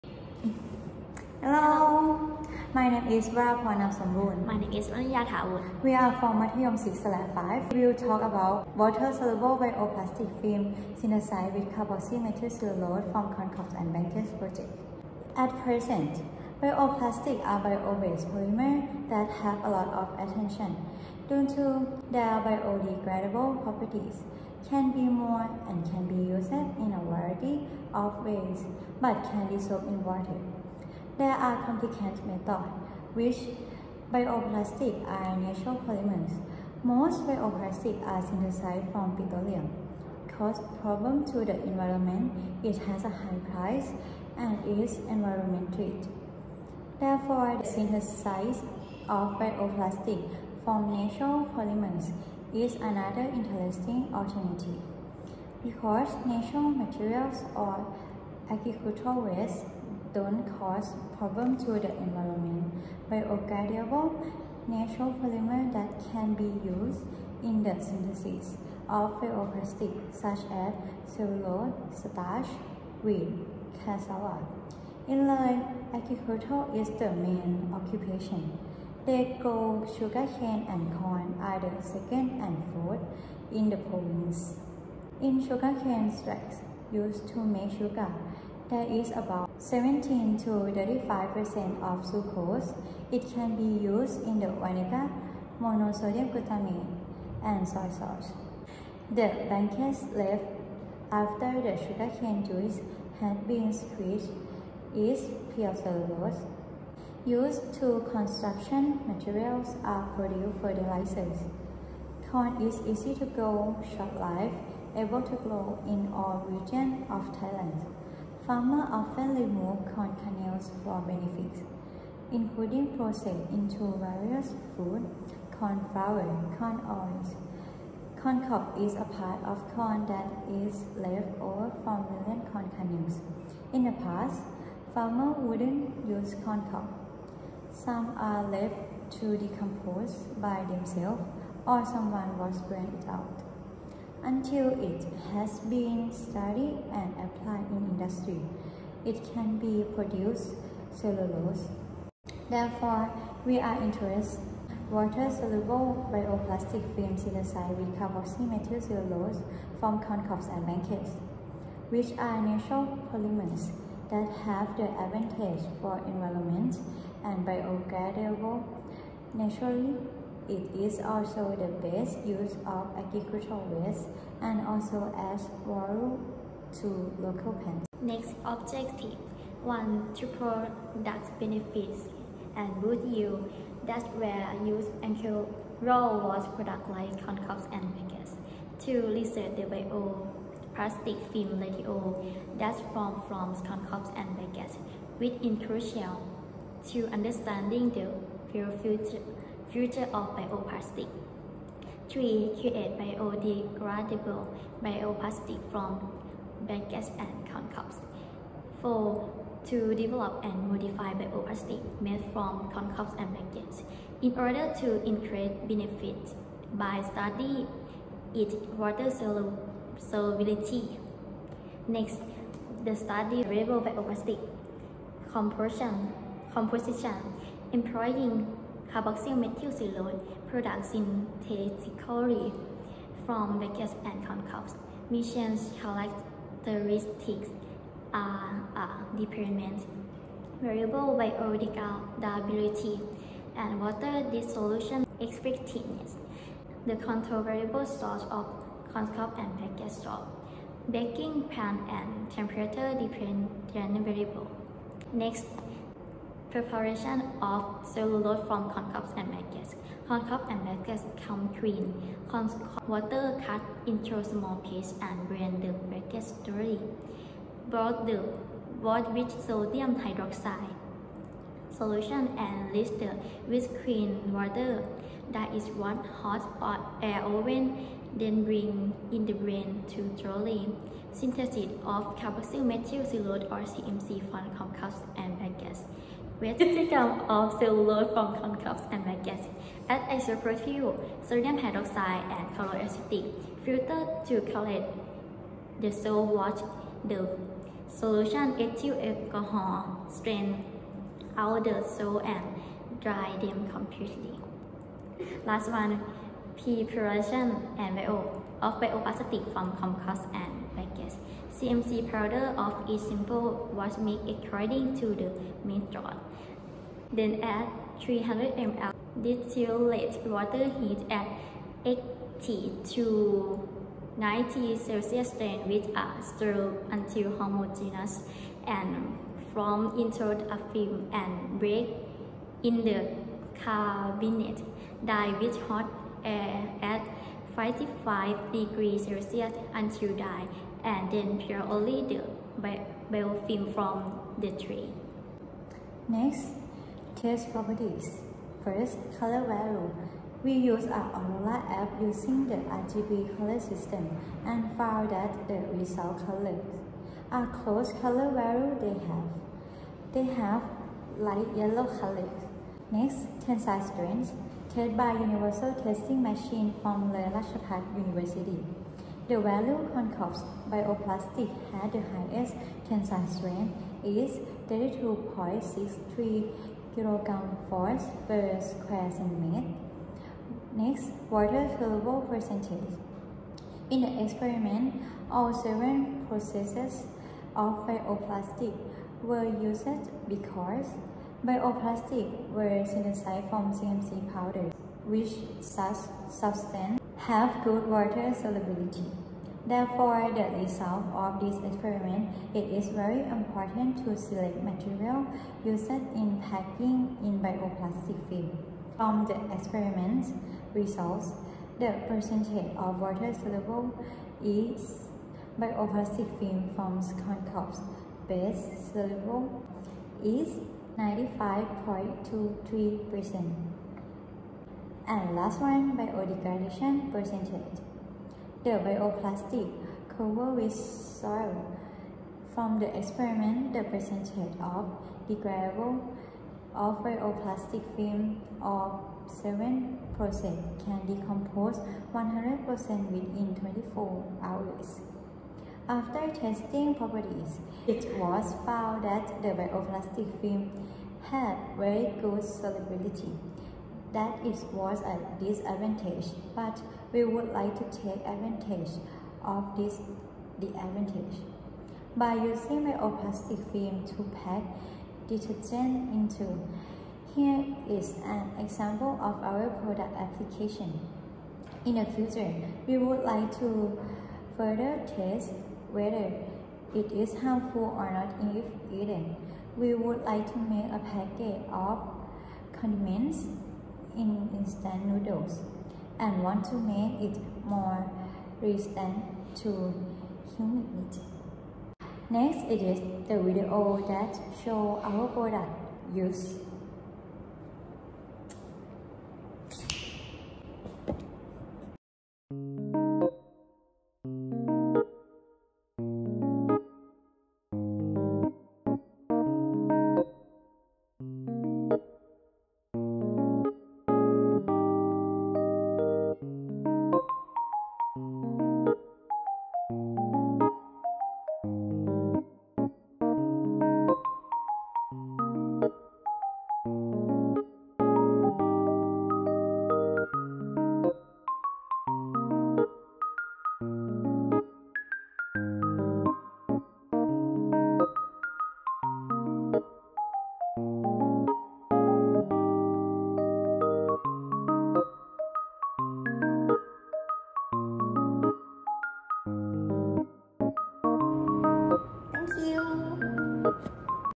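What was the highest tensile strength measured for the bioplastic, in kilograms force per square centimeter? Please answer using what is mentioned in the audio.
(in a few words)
32.63.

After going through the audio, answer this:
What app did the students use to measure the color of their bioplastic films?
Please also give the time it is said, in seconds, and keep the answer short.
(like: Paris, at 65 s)
Aurora, at 351 s.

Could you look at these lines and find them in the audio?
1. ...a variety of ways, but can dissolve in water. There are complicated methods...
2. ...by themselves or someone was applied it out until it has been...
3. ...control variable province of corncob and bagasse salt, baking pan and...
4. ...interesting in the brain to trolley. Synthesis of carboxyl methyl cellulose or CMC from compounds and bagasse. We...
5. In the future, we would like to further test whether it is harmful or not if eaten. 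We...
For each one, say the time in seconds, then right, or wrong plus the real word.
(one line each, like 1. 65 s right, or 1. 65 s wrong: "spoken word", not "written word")
1. 26 s right
2. 140 s wrong: "burned", not "applied"
3. 246 s wrong: "source", not "province"
4. 278 s wrong: "bring", not "interesting"
5. 471 s right.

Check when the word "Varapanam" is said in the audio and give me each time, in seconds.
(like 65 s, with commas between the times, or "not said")
3 s.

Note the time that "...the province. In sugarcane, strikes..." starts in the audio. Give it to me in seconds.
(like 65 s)
83 s.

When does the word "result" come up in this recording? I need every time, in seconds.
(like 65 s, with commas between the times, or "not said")
355 s, 400 s, 410 s.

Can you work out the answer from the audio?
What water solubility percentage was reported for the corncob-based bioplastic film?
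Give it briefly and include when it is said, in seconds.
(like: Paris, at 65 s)
95.23%, at 420 s.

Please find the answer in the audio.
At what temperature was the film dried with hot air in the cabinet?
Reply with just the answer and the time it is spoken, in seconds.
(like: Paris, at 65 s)
55 degrees Celsius, at 337 s.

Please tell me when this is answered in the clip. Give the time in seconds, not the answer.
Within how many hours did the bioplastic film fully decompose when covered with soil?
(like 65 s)
443 s.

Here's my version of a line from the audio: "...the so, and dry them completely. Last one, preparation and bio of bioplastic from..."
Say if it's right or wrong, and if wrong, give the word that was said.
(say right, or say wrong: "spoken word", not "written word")
right.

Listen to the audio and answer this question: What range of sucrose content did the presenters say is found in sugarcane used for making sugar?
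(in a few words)
17 to 35%.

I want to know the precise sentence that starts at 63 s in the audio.
Biodegradable natural polymer that can be used in the synthesis of plastic such as cellulose, starch, wheat, cassava.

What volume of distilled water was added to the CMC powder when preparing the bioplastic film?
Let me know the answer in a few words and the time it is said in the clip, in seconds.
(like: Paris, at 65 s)
300 ml, at 317 s.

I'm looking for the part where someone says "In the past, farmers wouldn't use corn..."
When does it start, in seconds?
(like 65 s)
133 s.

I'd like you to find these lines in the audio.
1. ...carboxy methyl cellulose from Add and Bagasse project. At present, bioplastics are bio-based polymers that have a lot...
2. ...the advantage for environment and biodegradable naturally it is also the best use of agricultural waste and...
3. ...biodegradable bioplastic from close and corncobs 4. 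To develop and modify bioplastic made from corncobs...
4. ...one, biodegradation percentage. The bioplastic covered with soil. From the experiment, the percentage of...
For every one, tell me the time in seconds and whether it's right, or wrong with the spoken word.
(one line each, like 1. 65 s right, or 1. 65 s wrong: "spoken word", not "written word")
1. 11 s wrong: "Corncobs", not "Add"
2. 164 s right
3. 202 s wrong: "bagasse", not "close"
4. 425 s right.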